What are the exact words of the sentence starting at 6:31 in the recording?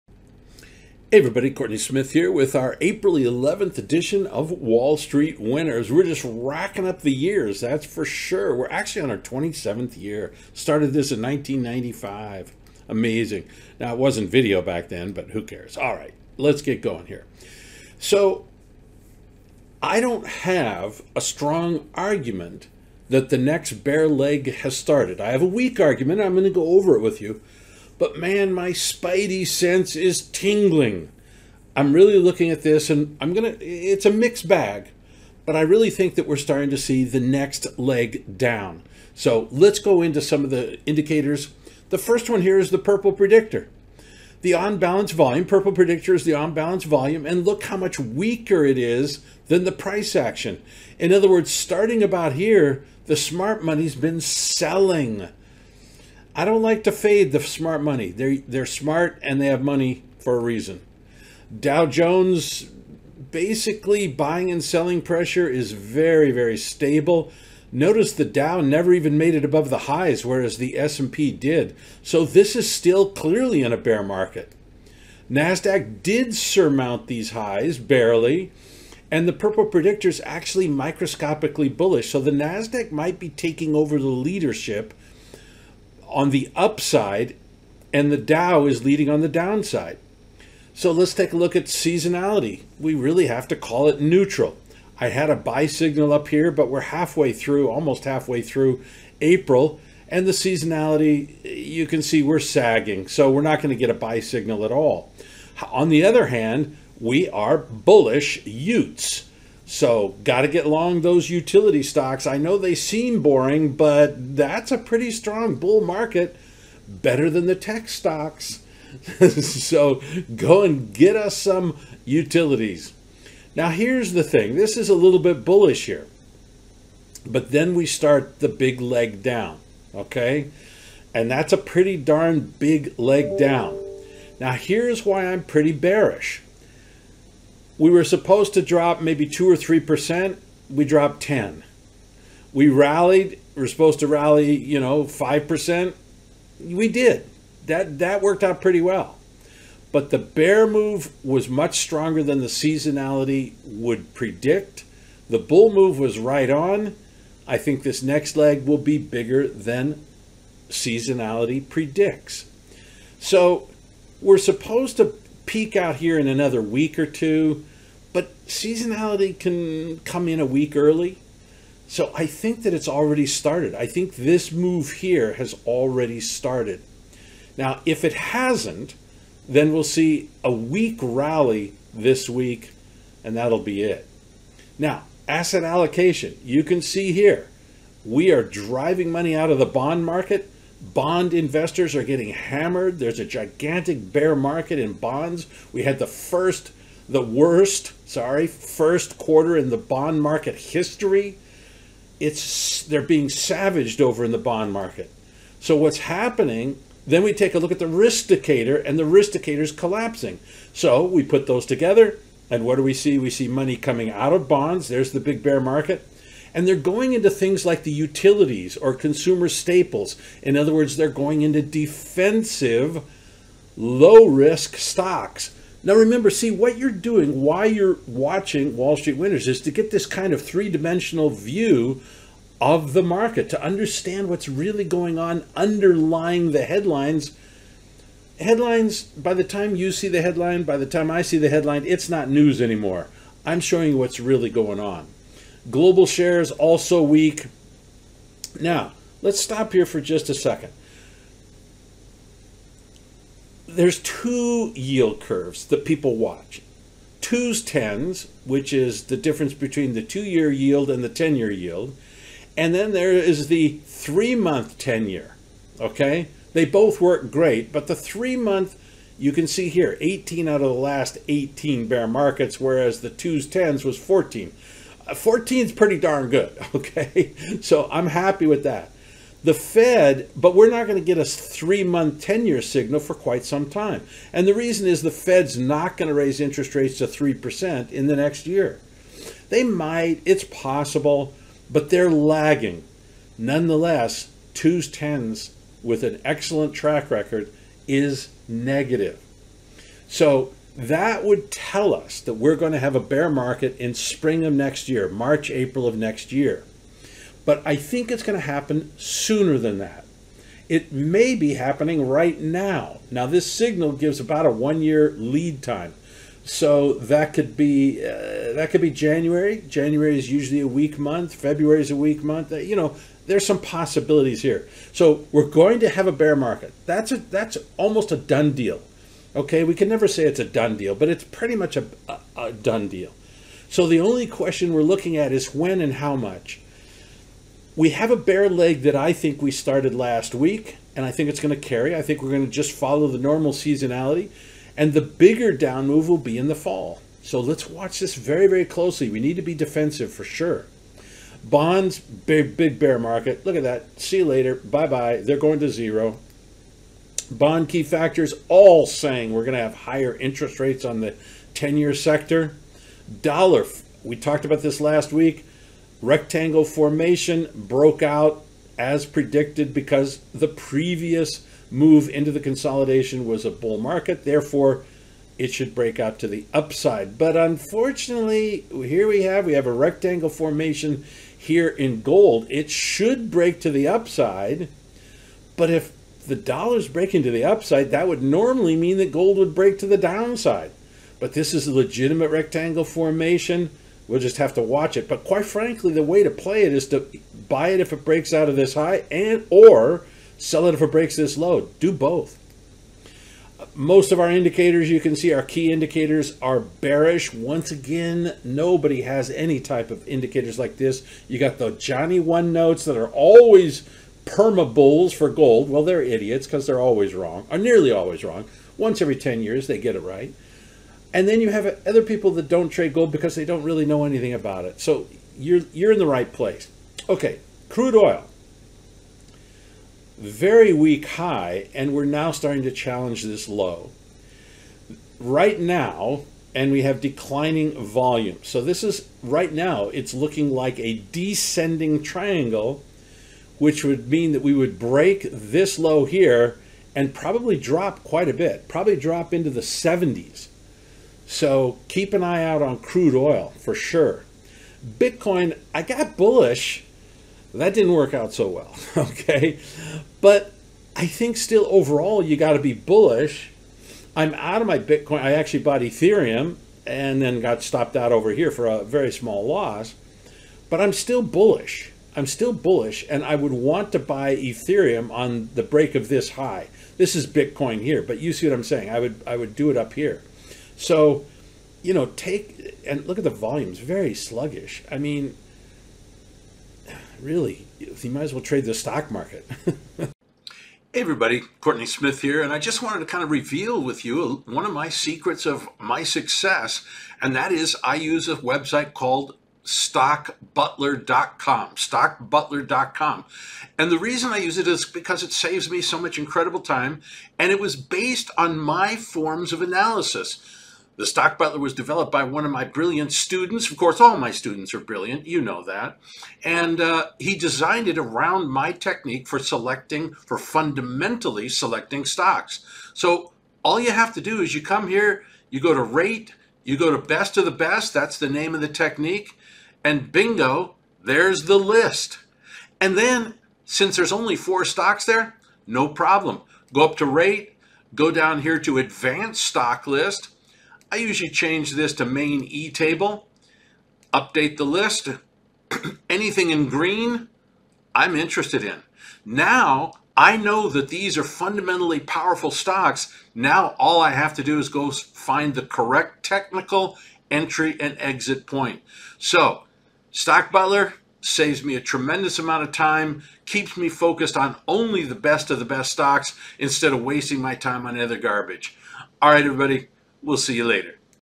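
But this is a legitimate rectangle formation.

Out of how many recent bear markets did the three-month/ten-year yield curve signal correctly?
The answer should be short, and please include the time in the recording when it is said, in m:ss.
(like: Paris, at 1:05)
18, at 4:30.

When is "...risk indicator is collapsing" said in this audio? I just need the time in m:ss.
3:29.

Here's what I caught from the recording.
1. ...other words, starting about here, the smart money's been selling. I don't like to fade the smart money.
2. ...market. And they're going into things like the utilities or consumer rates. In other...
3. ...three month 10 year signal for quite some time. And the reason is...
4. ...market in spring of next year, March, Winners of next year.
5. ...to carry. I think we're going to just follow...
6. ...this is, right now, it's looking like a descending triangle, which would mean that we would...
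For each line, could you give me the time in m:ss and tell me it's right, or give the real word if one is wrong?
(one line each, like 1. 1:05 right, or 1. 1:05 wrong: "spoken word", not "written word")
1. 0:51 right
2. 3:35 wrong: "staples", not "rates"
3. 4:41 right
4. 5:03 wrong: "April", not "Winners"
5. 5:41 right
6. 7:18 right.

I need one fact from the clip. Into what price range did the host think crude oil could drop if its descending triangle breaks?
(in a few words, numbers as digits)
the 70s.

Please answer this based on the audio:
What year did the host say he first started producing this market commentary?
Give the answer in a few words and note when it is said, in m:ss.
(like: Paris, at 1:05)
1995, at 0:11.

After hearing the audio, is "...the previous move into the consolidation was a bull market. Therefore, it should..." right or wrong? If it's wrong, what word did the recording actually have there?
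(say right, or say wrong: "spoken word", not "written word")
right.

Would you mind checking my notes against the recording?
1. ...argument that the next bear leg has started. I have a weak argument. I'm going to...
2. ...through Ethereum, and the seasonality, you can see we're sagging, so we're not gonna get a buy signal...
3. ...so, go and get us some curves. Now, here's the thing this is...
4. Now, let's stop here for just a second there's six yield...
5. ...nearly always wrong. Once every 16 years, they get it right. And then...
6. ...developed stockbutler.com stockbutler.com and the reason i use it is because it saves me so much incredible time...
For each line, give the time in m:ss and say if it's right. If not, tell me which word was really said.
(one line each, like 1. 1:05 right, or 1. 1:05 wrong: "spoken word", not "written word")
1. 0:21 right
2. 1:38 wrong: "April", not "Ethereum"
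3. 1:59 wrong: "utilities", not "curves"
4. 4:08 wrong: "two", not "six"
5. 6:57 wrong: "10", not "16"
6. 8:18 wrong: "called", not "developed".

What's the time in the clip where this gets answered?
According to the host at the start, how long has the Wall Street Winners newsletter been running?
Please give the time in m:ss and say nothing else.
0:09.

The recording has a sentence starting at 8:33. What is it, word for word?
Of course, all my students are brilliant, you know that.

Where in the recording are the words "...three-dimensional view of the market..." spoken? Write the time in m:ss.
3:50.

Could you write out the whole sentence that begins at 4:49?
They might, it's possible, but they're lagging.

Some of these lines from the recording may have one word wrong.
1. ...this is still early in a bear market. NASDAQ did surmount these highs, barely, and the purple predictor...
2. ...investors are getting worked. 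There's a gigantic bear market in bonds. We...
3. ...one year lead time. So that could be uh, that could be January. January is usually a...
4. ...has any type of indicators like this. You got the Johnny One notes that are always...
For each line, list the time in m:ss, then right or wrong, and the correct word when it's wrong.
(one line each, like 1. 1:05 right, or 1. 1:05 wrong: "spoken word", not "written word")
1. 1:12 wrong: "clearly", not "early"
2. 3:11 wrong: "hammered", not "worked"
3. 5:14 right
4. 6:49 right.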